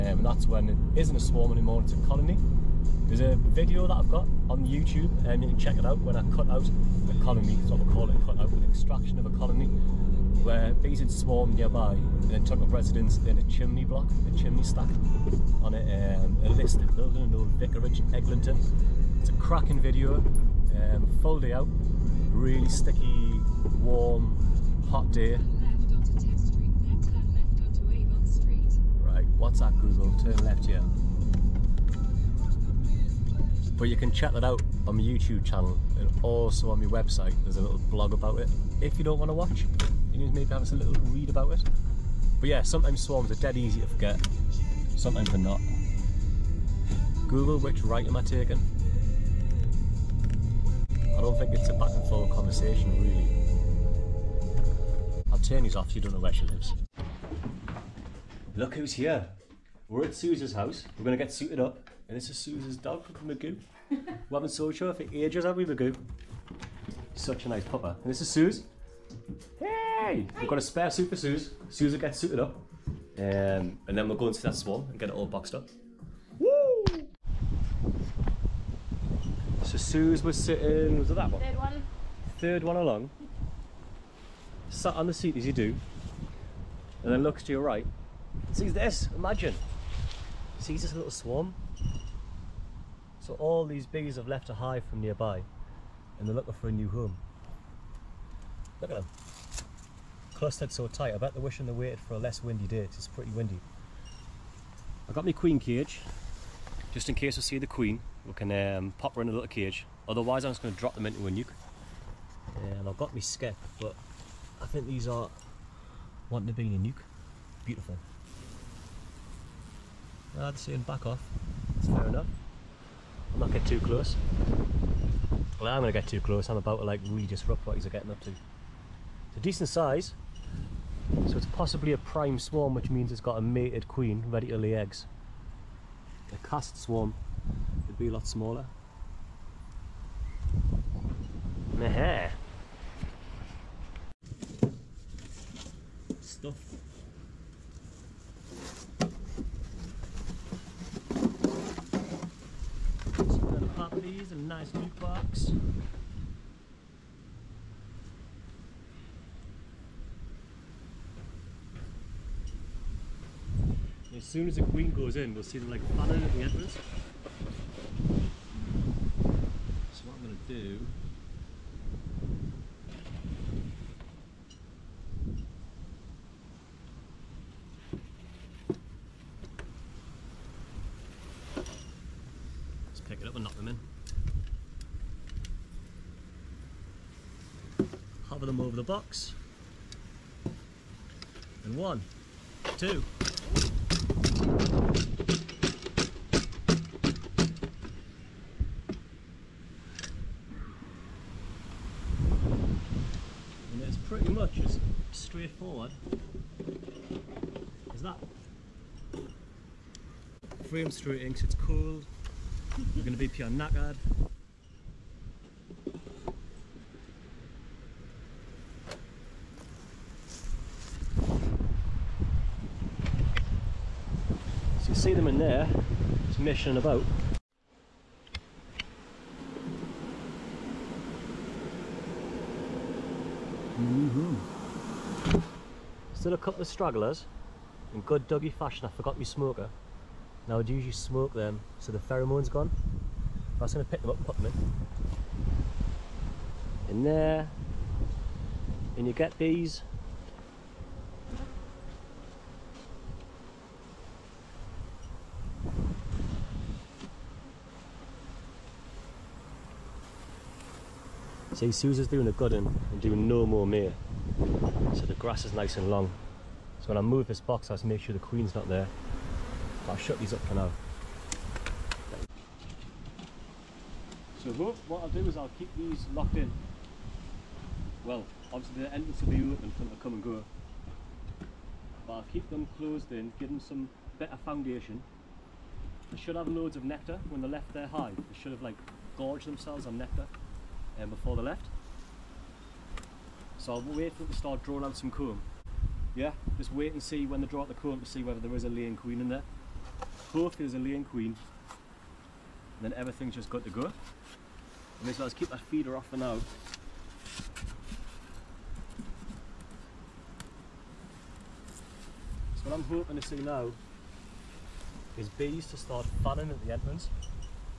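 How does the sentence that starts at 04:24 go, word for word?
So the grass is nice and long.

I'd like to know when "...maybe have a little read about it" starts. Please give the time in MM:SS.
00:40.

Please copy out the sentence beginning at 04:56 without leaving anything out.
Yeah, just wait and see when they draw out the comb to see whether there is a laying queen in there.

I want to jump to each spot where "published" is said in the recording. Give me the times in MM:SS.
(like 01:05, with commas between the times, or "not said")
not said.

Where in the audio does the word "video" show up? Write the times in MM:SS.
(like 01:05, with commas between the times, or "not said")
00:03, 00:19.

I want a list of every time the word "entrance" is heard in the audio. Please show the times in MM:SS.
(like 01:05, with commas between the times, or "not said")
02:46, 04:38, 05:16.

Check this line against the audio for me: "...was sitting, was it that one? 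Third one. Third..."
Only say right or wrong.
right.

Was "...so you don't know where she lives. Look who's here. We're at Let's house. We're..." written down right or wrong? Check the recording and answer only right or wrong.
wrong.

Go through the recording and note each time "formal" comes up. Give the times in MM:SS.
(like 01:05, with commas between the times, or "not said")
not said.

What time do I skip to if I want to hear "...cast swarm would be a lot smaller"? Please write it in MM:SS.
02:16.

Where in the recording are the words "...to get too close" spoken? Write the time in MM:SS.
02:05.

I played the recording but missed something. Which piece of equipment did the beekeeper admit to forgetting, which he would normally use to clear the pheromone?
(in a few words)
Smoker.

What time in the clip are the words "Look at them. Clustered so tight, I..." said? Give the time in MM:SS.
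01:38.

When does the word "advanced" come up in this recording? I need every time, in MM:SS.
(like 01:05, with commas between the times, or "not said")
not said.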